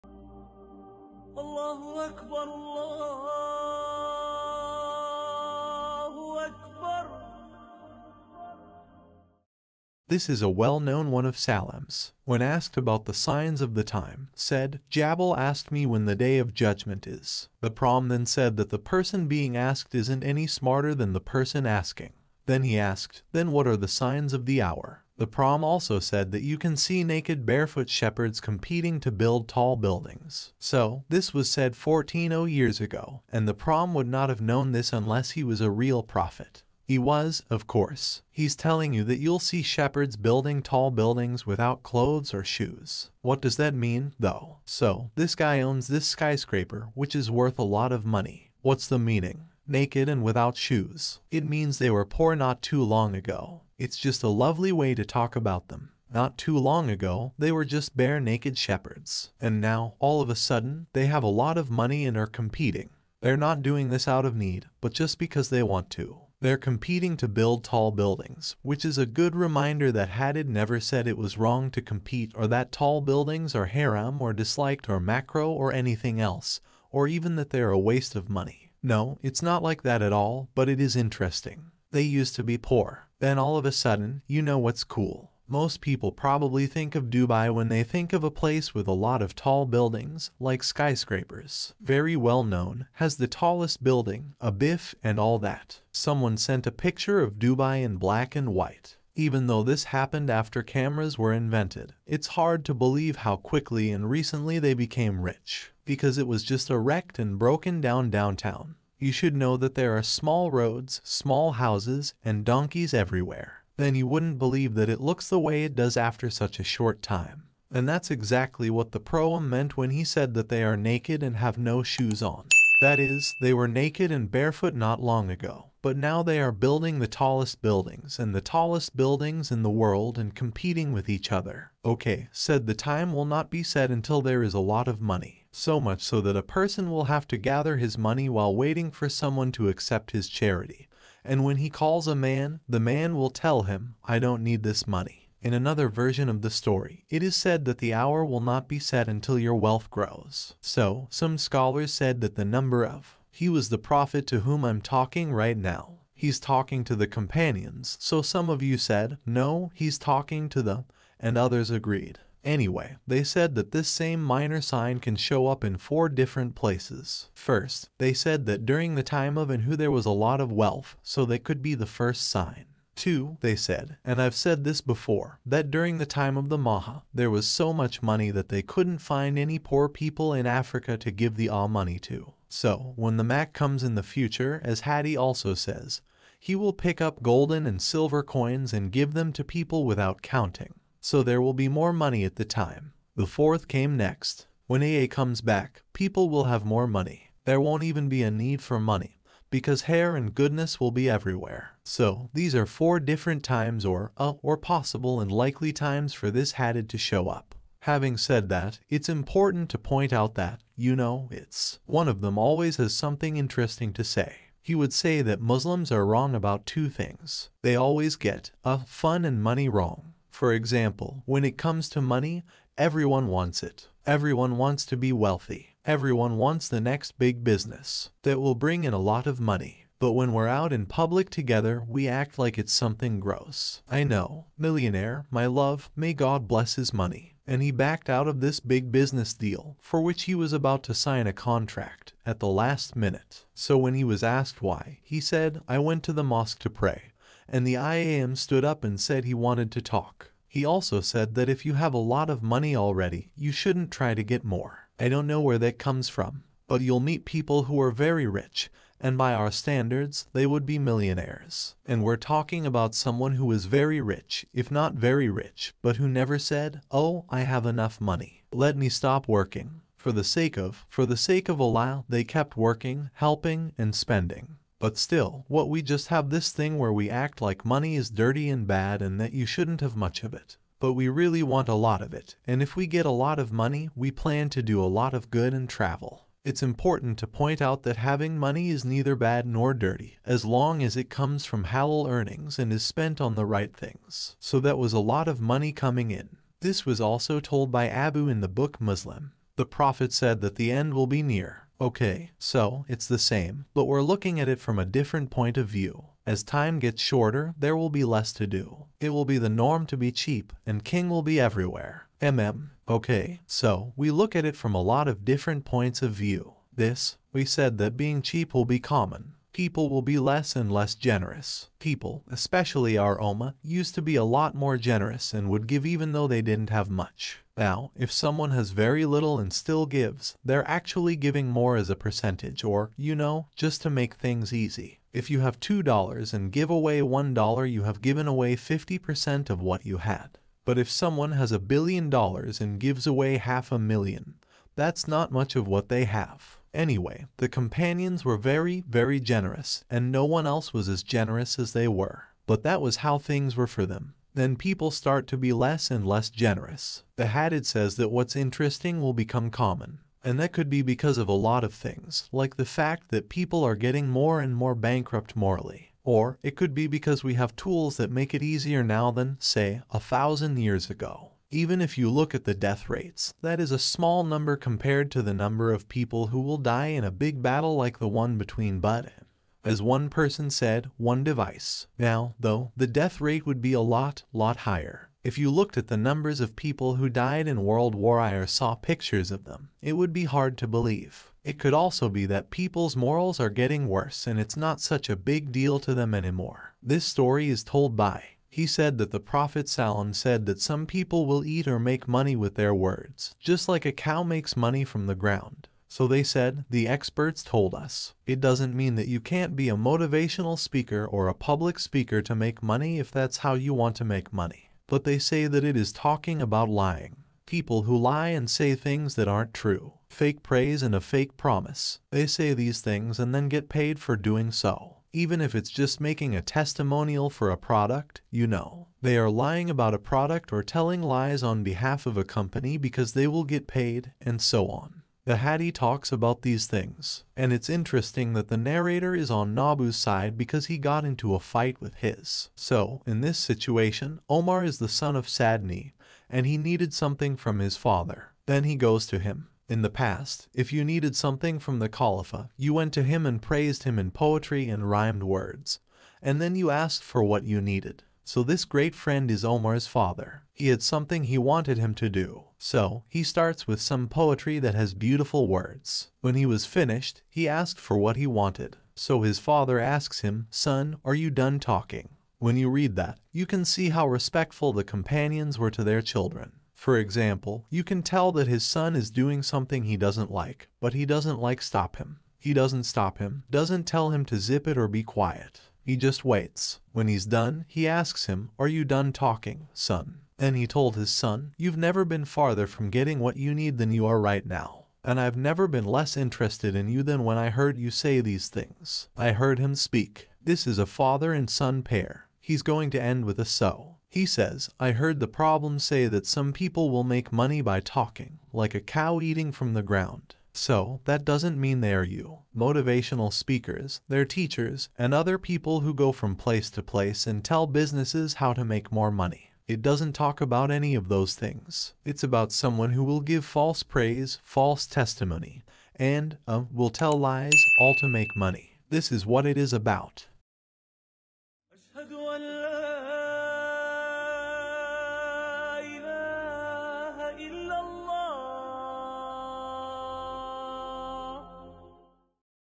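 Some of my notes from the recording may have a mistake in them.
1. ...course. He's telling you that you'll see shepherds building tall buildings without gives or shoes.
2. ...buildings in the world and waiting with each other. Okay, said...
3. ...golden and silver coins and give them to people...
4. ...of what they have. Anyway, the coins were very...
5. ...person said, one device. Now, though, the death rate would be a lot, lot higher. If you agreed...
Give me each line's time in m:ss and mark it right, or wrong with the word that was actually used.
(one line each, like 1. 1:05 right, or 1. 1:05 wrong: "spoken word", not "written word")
1. 0:37 wrong: "clothes", not "gives"
2. 2:08 wrong: "competing", not "waiting"
3. 3:07 right
4. 5:45 wrong: "companions", not "coins"
5. 6:20 wrong: "looked", not "agreed".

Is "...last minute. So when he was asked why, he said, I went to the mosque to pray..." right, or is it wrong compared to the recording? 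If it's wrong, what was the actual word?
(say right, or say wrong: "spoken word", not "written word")
right.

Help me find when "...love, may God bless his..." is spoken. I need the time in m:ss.
3:55.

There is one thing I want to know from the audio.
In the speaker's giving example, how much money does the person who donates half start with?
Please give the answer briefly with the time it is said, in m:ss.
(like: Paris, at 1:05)
$2, at 5:35.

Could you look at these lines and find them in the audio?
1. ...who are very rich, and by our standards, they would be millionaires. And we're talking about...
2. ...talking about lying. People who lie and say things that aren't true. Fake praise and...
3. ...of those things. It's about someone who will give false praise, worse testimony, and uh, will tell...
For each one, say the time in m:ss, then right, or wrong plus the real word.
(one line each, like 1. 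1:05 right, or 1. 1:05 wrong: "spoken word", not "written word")
1. 4:17 right
2. 6:55 right
3. 8:40 wrong: "false", not "worse".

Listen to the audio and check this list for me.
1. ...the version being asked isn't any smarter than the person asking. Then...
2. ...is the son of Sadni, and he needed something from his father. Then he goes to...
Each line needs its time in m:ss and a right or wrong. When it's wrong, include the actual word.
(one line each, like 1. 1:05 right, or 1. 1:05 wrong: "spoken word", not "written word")
1. 0:18 wrong: "person", not "version"
2. 7:24 right.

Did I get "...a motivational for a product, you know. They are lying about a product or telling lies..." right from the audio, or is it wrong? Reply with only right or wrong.
wrong.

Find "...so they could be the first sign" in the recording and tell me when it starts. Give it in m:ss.
2:51.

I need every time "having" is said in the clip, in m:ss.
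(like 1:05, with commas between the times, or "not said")
3:27, 4:47.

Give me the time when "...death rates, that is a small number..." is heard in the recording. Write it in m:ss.
6:12.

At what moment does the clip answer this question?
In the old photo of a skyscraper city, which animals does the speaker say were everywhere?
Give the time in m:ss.
1:52.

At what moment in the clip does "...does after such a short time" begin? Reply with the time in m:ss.
1:55.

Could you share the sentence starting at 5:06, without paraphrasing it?
As time gets shorter, there will be less to do.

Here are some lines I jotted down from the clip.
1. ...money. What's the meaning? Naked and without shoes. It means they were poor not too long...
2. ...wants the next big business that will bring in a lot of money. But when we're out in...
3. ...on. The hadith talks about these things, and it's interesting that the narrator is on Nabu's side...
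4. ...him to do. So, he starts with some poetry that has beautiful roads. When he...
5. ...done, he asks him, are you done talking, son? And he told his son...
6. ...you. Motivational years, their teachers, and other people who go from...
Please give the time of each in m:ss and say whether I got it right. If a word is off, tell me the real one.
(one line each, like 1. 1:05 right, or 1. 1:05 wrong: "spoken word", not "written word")
1. 0:48 right
2. 3:46 right
3. 7:14 right
4. 7:41 wrong: "words", not "roads"
5. 8:07 right
6. 8:32 wrong: "speakers", not "years".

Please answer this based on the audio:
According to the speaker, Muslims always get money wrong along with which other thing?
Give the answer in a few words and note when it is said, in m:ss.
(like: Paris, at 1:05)
Fun, at 3:38.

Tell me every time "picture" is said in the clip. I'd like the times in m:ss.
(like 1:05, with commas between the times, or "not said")
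1:36, 6:28.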